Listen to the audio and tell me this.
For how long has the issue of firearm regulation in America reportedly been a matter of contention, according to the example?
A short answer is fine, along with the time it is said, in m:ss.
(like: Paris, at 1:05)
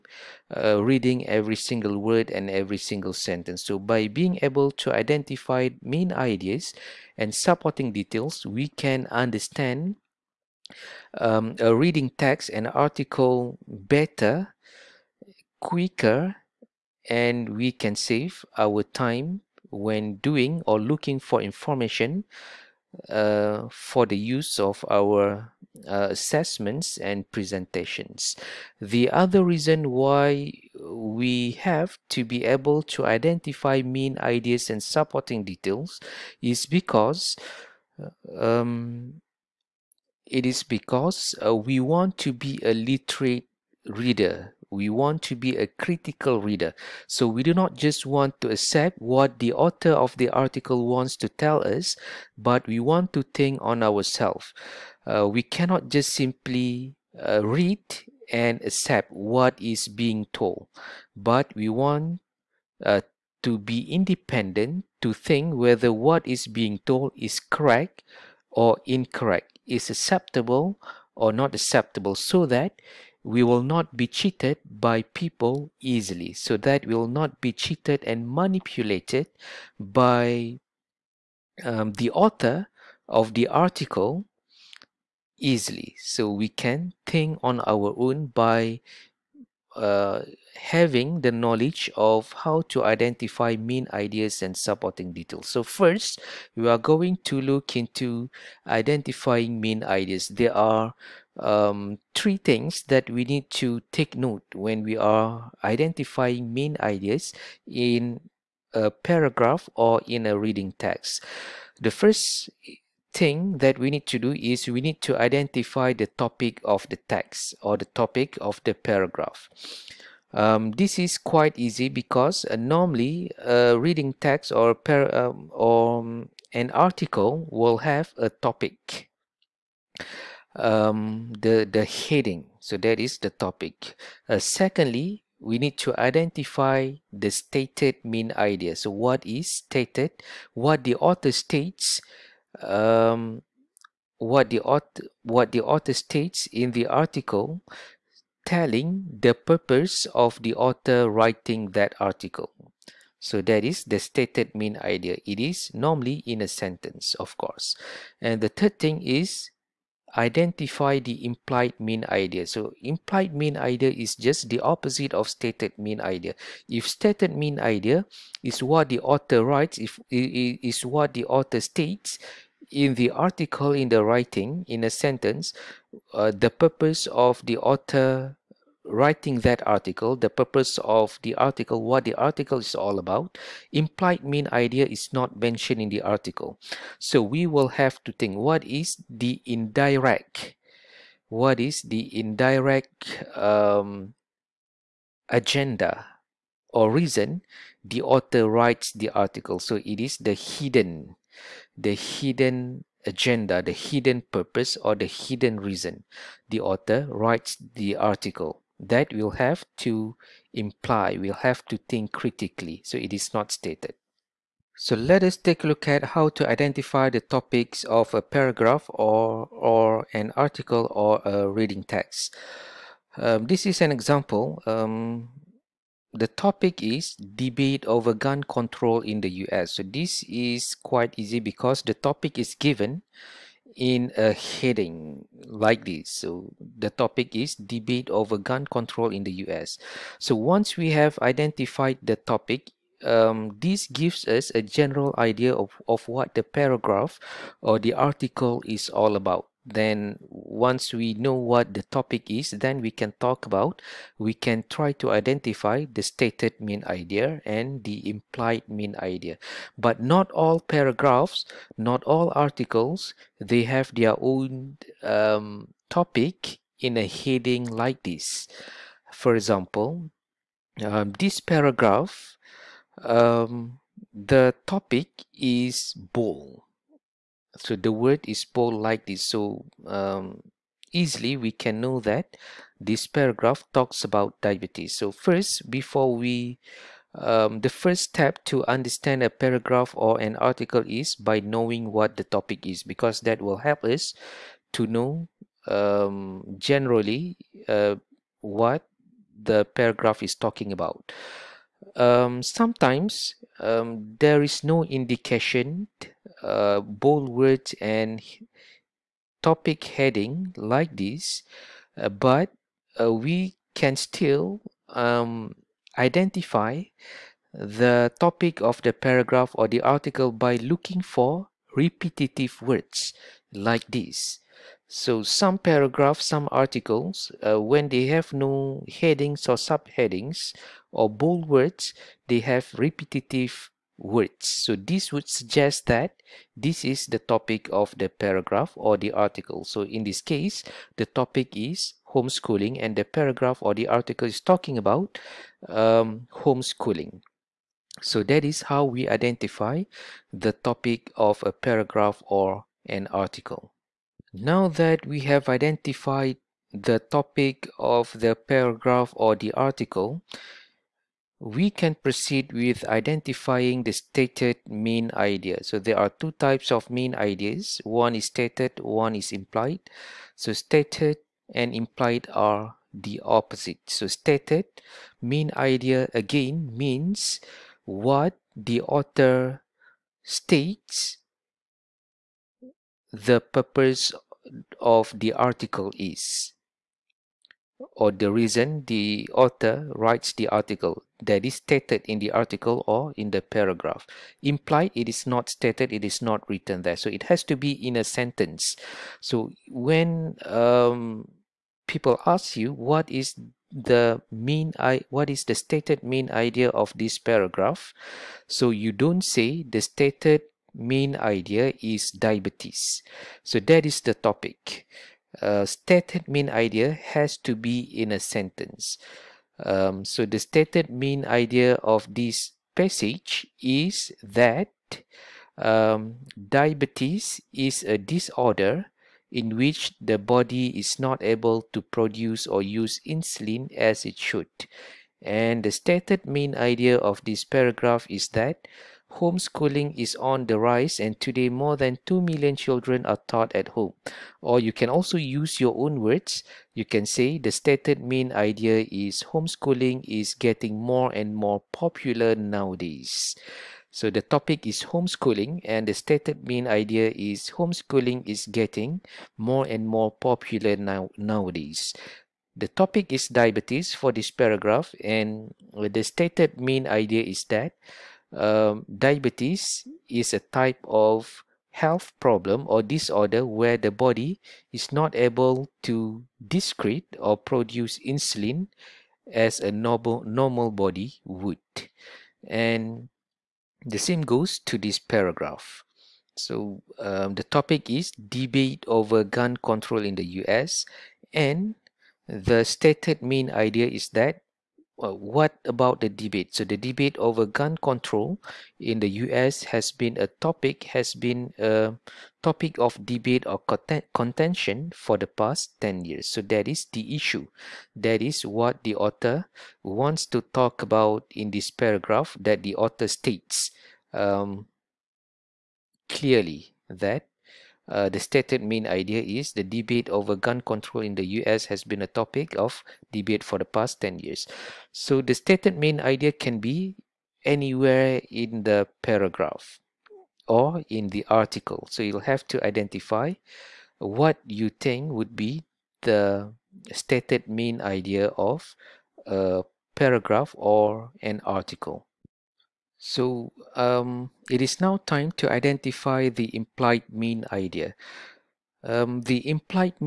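10 years, at 8:25.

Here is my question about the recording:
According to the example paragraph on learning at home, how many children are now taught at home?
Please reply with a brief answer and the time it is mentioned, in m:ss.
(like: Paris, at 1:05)
More than 2 million, at 7:21.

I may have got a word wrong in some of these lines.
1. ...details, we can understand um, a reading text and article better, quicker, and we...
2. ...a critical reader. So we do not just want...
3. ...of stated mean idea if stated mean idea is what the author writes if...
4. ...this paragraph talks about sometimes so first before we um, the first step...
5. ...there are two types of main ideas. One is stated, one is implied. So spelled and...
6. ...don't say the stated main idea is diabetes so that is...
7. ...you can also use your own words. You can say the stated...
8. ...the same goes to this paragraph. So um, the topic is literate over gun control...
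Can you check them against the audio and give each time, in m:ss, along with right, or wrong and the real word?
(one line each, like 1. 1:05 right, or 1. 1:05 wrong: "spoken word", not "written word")
1. 0:07 right
2. 0:45 right
3. 2:45 right
4. 4:42 wrong: "diabetes", not "sometimes"
5. 6:05 wrong: "stated", not "spelled"
6. 6:48 right
7. 7:24 right
8. 8:03 wrong: "debate", not "literate".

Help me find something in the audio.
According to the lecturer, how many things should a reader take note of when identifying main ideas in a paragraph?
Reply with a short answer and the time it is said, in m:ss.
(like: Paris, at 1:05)
3, at 1:42.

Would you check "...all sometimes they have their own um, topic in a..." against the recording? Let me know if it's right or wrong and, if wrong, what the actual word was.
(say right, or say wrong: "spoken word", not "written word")
wrong: "articles", not "sometimes".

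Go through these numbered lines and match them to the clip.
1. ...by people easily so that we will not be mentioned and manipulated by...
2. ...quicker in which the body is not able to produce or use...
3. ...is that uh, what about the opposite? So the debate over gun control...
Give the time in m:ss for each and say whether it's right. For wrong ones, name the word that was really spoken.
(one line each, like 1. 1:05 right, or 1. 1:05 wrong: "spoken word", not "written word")
1. 1:14 wrong: "cheated", not "mentioned"
2. 7:07 wrong: "disorder", not "quicker"
3. 8:13 wrong: "debate", not "opposite".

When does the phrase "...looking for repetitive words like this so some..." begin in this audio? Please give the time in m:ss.
5:20.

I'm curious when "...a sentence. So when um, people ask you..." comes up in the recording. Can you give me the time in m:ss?
6:37.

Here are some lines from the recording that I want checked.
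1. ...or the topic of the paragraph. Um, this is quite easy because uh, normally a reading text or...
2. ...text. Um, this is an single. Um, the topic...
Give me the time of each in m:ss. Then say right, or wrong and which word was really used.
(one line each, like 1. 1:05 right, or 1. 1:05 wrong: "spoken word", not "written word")
1. 1:57 right
2. 3:41 wrong: "example", not "single".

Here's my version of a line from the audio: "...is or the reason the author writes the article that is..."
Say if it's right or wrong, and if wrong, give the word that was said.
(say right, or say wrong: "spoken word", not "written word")
right.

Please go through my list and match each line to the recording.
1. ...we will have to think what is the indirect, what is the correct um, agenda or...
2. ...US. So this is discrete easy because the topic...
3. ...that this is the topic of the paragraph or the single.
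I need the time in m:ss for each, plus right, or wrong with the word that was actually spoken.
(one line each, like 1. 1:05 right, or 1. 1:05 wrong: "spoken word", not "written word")
1. 3:07 wrong: "indirect", not "correct"
2. 3:49 wrong: "quite", not "discrete"
3. 5:35 wrong: "article", not "single".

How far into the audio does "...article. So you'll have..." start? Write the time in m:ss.
8:51.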